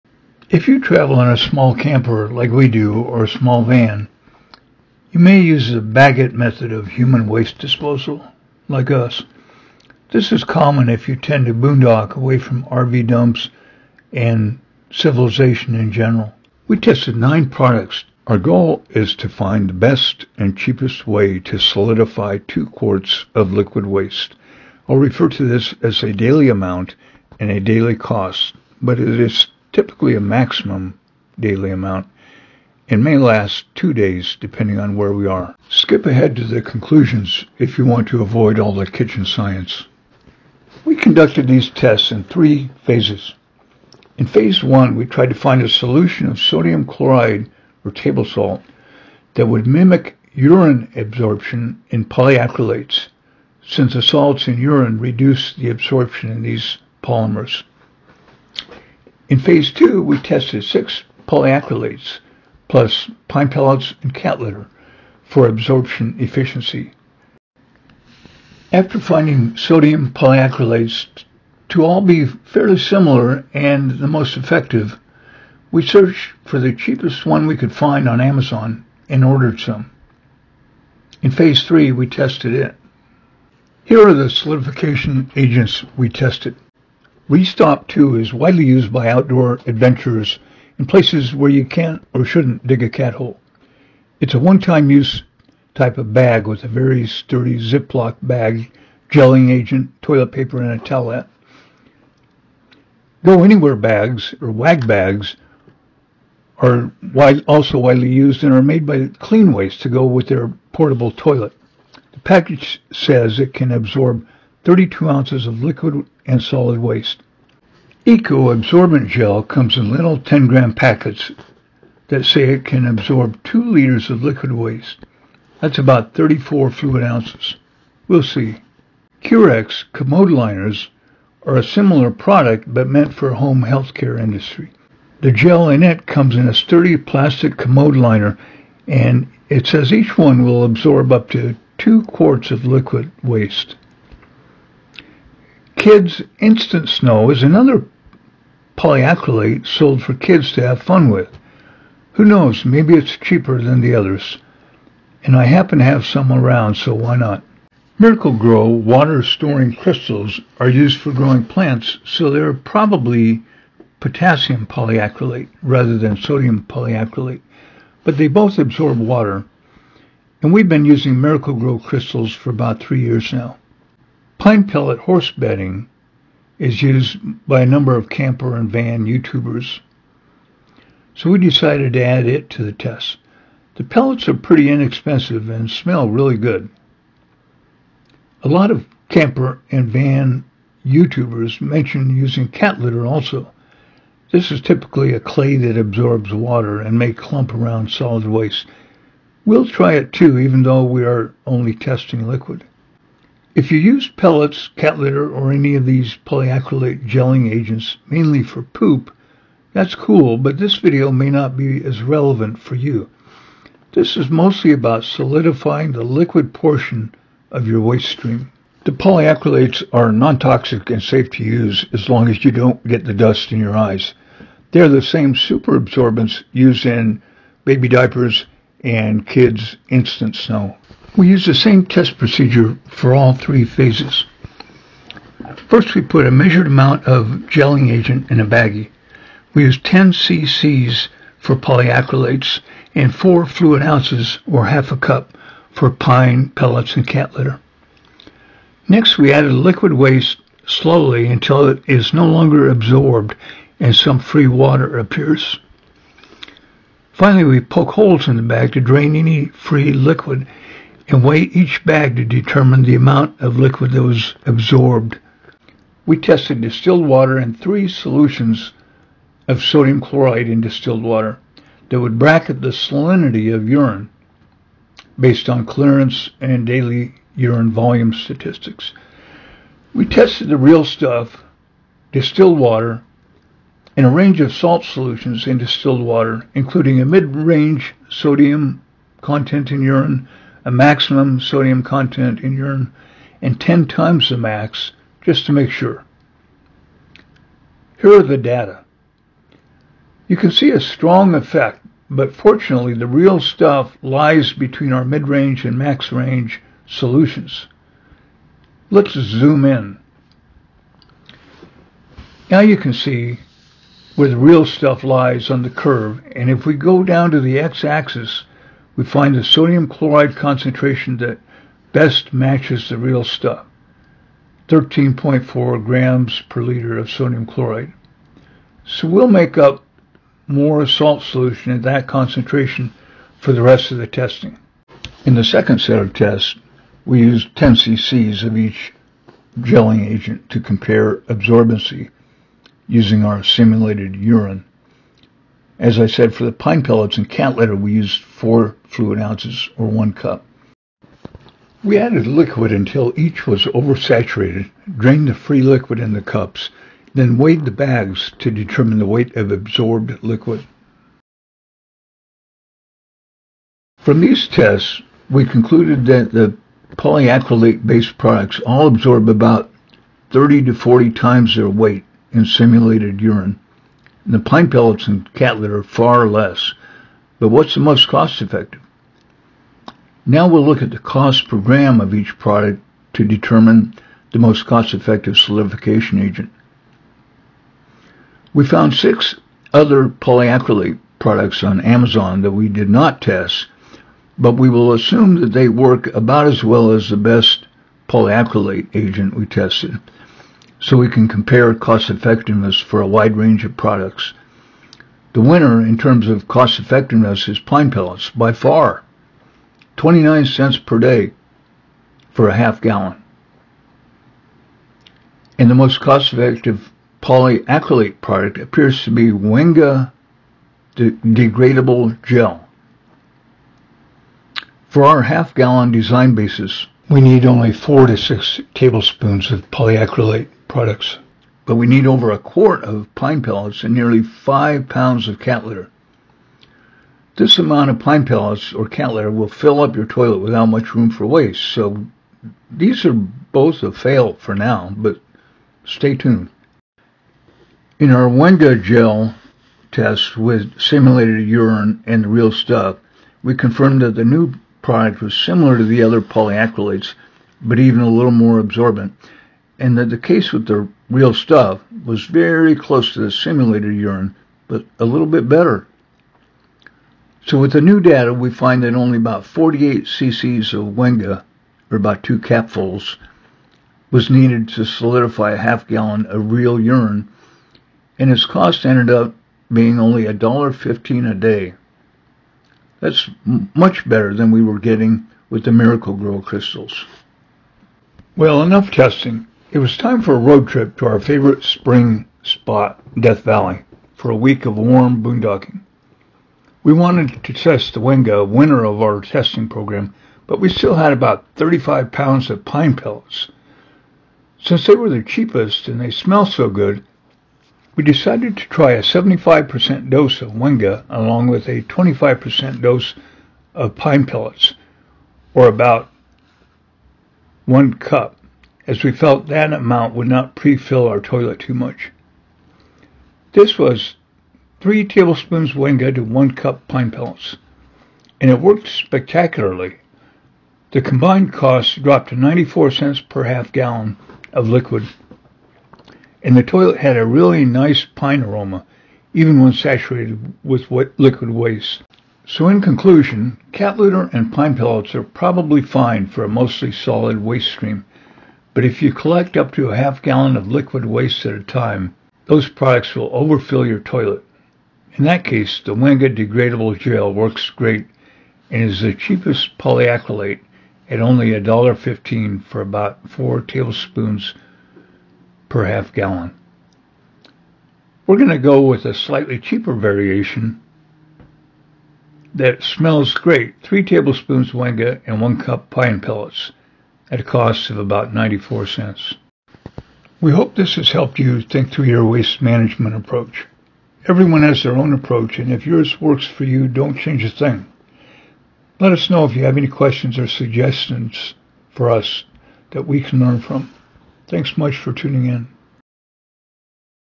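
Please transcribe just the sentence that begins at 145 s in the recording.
Kids Instant Snow is another polyacrylate sold for kids to have fun with.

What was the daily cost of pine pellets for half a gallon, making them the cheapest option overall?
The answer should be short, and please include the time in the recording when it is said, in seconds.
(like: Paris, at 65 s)
29 cents, at 409 s.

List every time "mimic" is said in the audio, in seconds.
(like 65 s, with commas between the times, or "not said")
49 s.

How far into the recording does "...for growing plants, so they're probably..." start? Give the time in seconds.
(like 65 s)
160 s.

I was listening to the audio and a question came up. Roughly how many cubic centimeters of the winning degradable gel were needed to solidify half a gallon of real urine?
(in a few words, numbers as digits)
48 cc.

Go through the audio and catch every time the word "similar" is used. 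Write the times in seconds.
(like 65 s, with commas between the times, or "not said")
72 s, 131 s, 455 s.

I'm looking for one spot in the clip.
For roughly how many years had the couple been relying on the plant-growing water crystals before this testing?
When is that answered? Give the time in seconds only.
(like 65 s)
172 s.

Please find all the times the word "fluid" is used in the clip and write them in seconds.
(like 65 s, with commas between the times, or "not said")
126 s, 243 s, 348 s.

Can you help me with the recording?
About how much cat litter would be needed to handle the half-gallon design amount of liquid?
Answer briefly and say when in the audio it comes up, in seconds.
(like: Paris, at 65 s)
nearly 5 pounds, at 433 s.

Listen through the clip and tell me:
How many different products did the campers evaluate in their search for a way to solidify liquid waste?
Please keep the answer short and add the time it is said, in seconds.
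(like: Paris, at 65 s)
9, at 17 s.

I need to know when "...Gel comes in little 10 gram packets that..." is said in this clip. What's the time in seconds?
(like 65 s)
119 s.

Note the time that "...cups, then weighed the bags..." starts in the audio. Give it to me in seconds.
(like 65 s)
356 s.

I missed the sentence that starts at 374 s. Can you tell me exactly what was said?
And the pine pellets and cat litter far less, but what's the most cost effective?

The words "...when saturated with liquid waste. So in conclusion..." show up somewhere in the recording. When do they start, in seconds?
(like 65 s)
539 s.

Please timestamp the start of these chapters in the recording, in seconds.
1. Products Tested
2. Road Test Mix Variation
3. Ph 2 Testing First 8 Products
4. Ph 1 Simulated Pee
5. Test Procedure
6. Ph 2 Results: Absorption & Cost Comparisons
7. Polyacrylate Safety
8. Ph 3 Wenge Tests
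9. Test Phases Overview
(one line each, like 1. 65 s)
1. 83 s
2. 489 s
3. 335 s
4. 266 s
5. 231 s
6. 361 s
7. 219 s
8. 448 s
9. 41 s.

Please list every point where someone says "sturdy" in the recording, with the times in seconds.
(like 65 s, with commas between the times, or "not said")
97 s, 136 s.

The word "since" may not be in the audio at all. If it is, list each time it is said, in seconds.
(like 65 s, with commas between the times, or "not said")
53 s, 504 s.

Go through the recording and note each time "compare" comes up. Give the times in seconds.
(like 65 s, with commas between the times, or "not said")
340 s, 401 s.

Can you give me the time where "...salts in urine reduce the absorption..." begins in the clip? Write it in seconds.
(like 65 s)
54 s.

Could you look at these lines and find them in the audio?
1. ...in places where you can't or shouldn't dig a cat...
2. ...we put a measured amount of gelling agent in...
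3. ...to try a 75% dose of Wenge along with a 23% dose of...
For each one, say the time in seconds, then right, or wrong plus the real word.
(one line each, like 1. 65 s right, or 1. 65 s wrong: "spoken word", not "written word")
1. 90 s right
2. 235 s right
3. 508 s wrong: "25", not "23".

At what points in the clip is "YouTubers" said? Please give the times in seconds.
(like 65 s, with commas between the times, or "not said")
179 s, 190 s.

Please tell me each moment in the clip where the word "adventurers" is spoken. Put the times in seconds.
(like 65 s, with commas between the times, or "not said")
89 s.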